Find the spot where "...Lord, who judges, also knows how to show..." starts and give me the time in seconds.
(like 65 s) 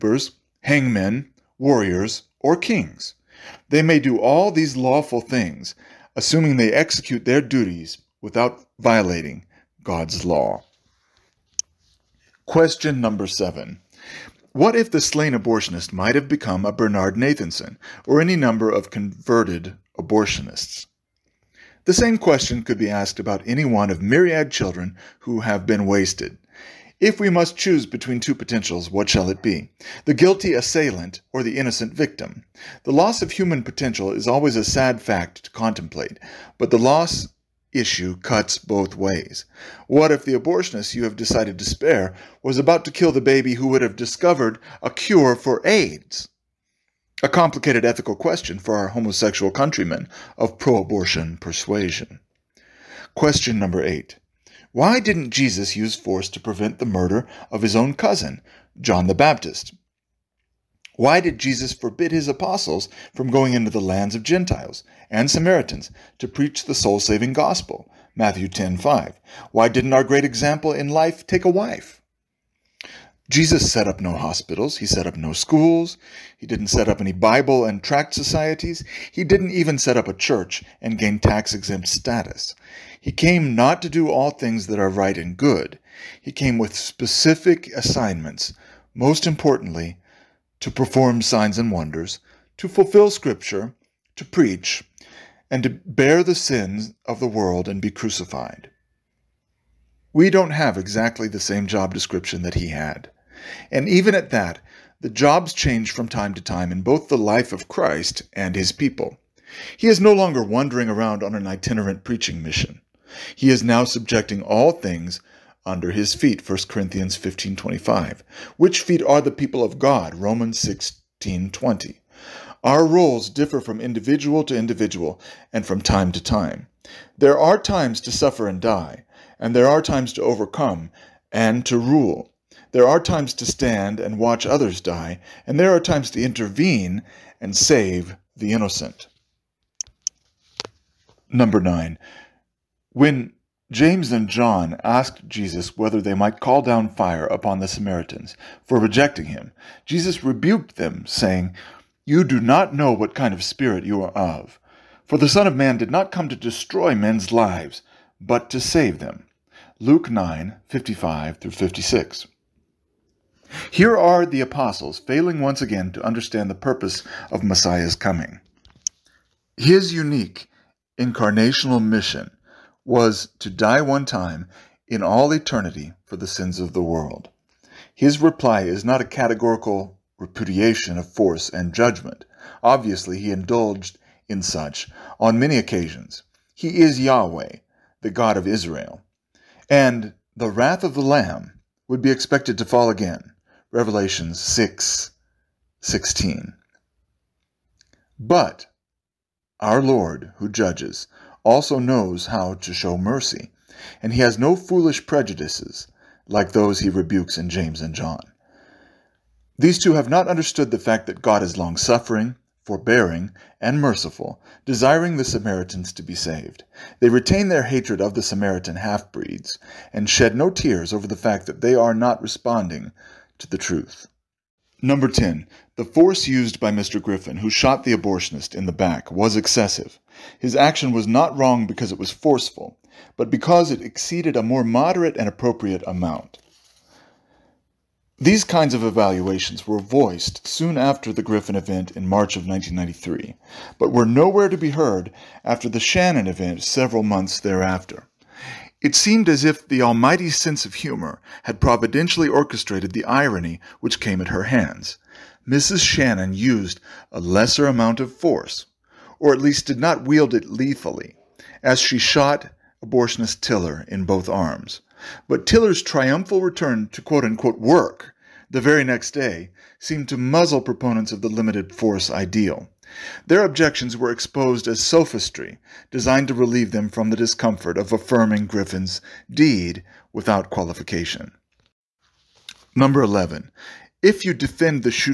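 199 s.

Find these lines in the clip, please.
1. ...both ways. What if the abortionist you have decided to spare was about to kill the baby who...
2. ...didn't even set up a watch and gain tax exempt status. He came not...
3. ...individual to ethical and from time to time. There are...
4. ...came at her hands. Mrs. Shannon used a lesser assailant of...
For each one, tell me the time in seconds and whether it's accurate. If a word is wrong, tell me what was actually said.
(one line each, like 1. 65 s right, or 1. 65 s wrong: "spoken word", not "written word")
1. 38 s right
2. 79 s wrong: "church", not "watch"
3. 123 s wrong: "individual", not "ethical"
4. 253 s wrong: "amount", not "assailant".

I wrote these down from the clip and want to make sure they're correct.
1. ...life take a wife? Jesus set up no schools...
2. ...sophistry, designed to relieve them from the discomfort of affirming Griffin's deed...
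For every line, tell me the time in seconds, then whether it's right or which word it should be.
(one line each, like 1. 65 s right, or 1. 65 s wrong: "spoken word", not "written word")
1. 70 s wrong: "hospitals", not "schools"
2. 274 s right.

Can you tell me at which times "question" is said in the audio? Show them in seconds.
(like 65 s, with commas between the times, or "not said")
12 s, 22 s, 48 s, 53 s.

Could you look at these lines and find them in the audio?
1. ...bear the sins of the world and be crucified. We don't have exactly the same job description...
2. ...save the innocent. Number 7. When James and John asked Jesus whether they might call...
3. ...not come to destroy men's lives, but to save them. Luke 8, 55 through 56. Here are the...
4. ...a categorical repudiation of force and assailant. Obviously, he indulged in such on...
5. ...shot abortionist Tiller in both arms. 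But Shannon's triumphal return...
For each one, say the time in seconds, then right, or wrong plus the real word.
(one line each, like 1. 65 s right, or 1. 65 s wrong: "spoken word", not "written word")
1. 95 s right
2. 137 s wrong: "9", not "7"
3. 155 s wrong: "9", not "8"
4. 178 s wrong: "judgment", not "assailant"
5. 261 s wrong: "Tiller", not "Shannon".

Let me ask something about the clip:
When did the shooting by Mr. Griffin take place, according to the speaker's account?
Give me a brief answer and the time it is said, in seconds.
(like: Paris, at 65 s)
March 1993, at 242 s.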